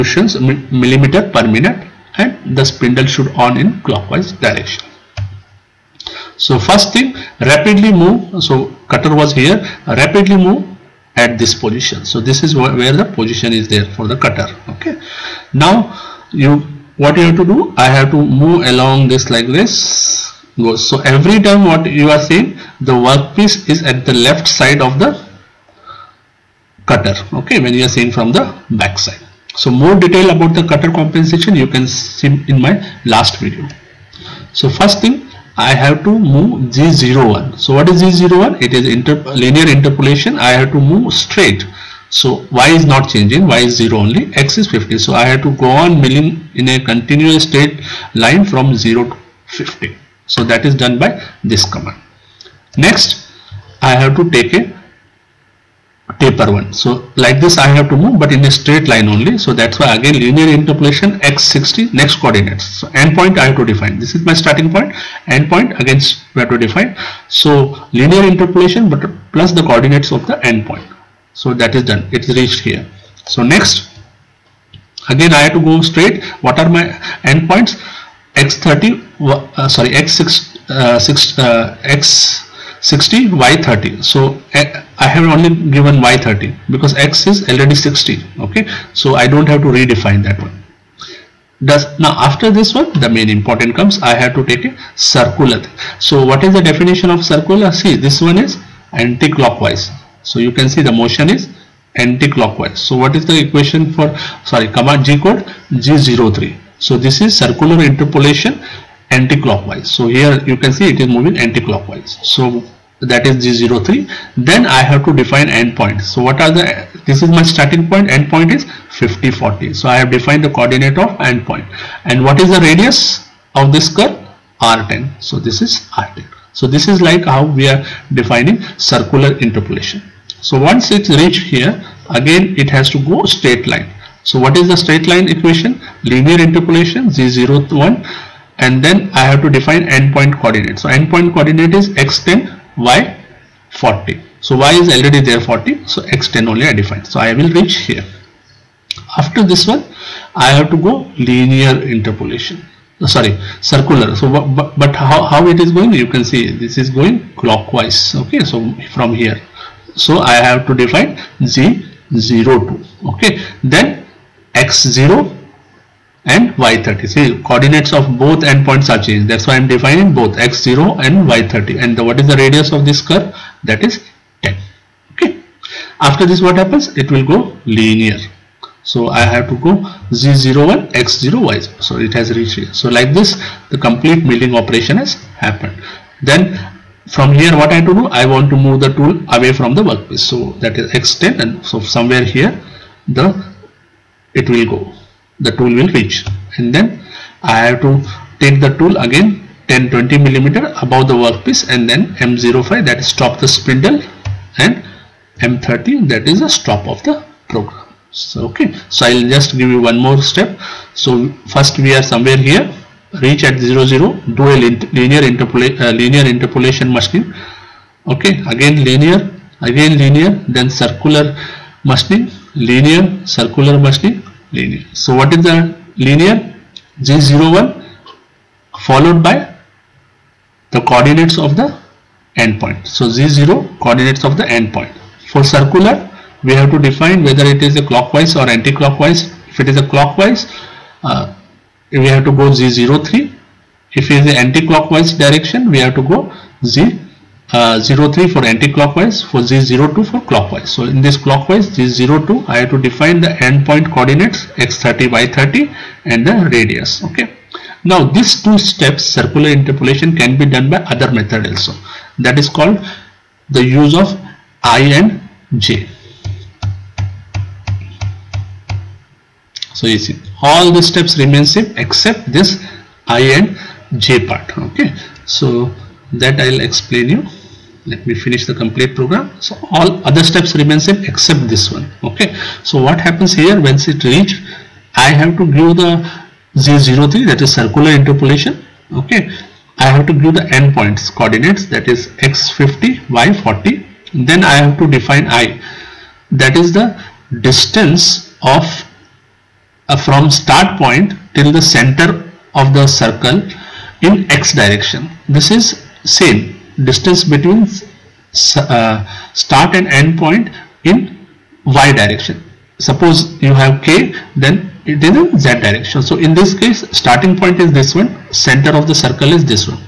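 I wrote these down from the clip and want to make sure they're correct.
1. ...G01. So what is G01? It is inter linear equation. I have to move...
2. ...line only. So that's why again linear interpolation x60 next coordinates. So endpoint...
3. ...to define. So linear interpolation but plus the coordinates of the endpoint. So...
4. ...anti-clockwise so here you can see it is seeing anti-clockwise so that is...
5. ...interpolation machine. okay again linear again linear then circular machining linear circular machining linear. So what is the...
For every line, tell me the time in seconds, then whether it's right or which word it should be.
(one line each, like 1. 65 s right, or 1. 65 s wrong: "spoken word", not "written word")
1. 36 s wrong: "interpolation", not "equation"
2. 58 s right
3. 66 s right
4. 109 s wrong: "moving", not "seeing"
5. 216 s right.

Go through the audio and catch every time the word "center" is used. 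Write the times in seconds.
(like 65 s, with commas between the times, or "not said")
301 s, 318 s.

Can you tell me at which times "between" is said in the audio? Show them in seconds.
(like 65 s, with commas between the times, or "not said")
307 s.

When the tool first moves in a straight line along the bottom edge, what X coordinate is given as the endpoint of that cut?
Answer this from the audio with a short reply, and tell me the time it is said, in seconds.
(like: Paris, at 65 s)
50, at 44 s.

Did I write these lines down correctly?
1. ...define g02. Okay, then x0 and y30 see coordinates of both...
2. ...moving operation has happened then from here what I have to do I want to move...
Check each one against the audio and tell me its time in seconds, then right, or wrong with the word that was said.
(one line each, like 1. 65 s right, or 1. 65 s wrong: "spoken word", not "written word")
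1. 160 s right
2. 184 s wrong: "milling", not "moving".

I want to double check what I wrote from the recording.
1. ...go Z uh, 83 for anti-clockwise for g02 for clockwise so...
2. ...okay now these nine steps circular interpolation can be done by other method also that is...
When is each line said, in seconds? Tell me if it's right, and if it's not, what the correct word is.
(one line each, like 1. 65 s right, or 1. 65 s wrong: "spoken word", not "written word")
1. 246 s wrong: "03", not "83"
2. 257 s wrong: "two", not "nine".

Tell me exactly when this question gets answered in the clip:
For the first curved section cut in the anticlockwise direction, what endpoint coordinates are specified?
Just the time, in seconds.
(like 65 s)
118 s.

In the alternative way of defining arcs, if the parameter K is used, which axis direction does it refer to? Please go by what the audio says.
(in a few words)
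Z direction.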